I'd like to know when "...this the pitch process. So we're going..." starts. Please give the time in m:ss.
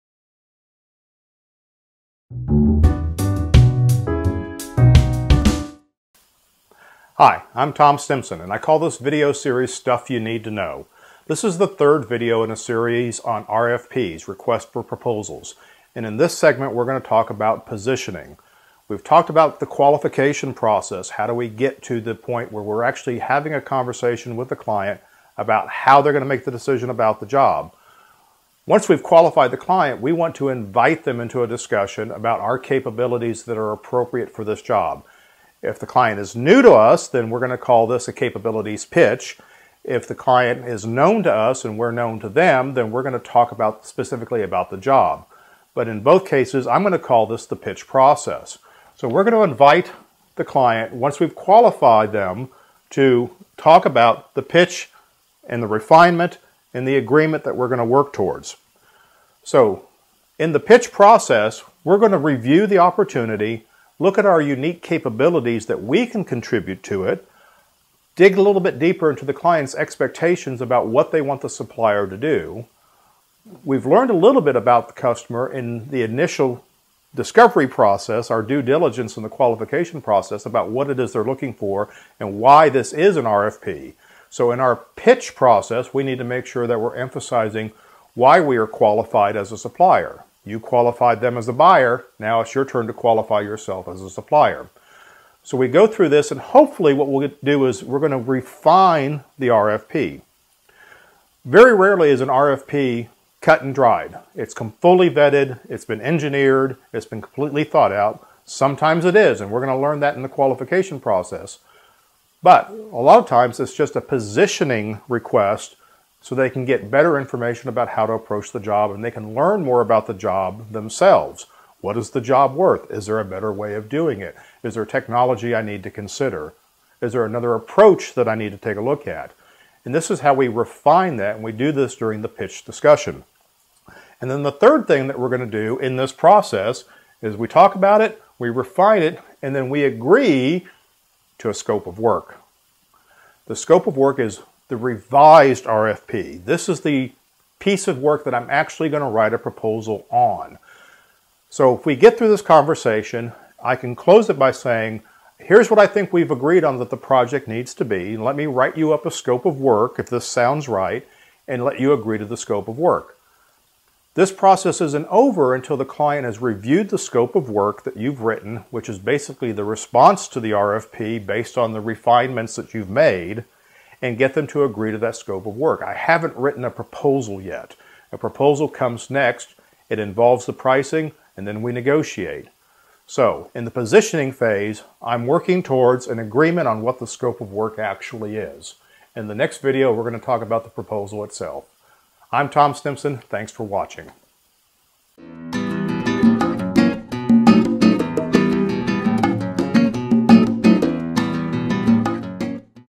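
0:47.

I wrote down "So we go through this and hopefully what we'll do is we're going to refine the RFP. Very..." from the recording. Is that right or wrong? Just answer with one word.
right.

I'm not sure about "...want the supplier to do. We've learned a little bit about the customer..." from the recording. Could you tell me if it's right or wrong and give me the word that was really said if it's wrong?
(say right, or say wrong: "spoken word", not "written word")
right.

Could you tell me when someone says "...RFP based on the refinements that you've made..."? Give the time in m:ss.
2:50.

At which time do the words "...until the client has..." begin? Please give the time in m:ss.
2:45.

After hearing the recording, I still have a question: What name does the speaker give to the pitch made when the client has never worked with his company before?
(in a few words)
capabilities pitch.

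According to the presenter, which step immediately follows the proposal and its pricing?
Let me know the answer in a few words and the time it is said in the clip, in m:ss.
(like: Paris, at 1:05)
negotiate, at 3:01.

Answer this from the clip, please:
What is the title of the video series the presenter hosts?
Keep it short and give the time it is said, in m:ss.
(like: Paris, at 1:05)
Stuff You Need to Know, at 0:09.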